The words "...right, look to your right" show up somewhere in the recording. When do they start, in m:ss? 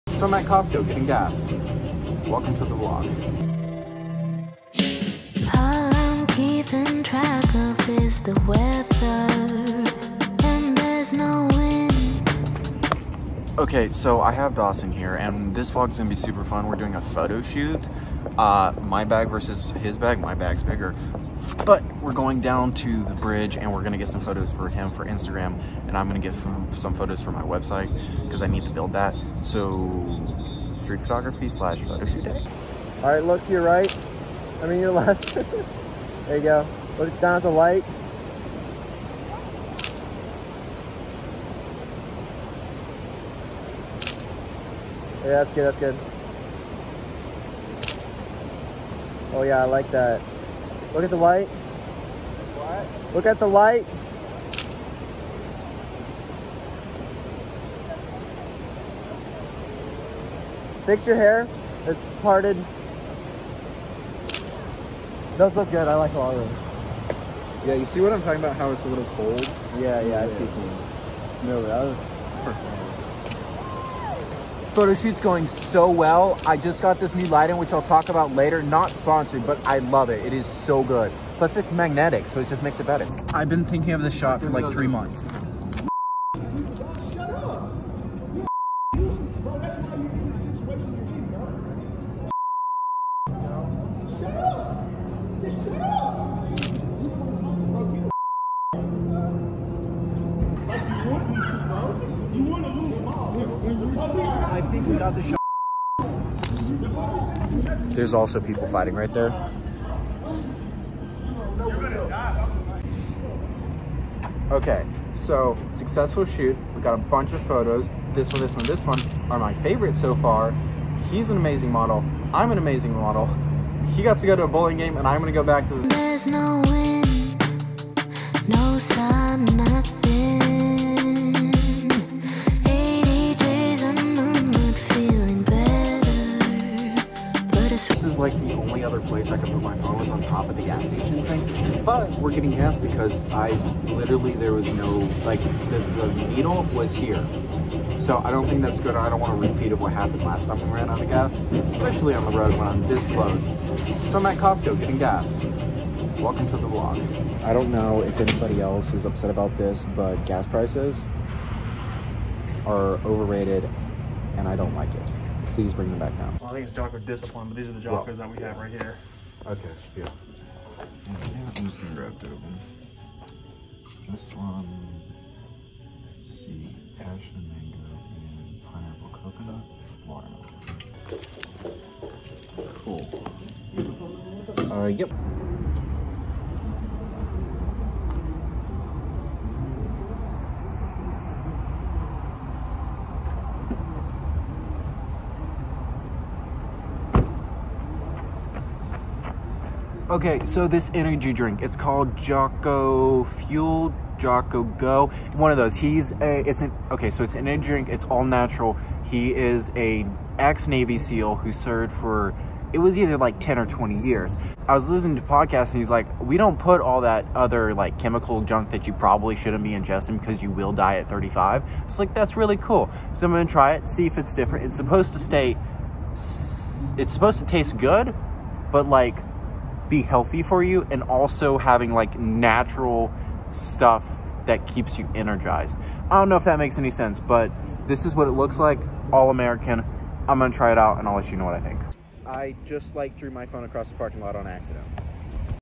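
0:33.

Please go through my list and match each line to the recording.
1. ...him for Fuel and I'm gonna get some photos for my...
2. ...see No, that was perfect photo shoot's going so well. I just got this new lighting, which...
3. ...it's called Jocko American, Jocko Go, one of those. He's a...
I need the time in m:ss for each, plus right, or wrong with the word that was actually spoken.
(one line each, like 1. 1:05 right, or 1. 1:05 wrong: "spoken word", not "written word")
1. 0:24 wrong: "Instagram", not "Fuel"
2. 1:10 right
3. 3:21 wrong: "Fuel", not "American".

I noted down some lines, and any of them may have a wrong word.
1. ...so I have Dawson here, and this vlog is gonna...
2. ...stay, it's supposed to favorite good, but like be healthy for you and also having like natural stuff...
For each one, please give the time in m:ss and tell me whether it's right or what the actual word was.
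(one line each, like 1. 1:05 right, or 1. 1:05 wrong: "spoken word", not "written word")
1. 0:13 right
2. 3:45 wrong: "taste", not "favorite".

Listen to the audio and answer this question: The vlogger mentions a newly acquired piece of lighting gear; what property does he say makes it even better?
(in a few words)
magnetic.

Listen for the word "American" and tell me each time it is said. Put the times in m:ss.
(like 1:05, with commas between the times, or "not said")
3:59.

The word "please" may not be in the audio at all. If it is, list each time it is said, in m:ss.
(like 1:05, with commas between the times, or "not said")
2:45.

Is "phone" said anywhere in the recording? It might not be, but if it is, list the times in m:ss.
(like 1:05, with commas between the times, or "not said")
2:19, 4:03.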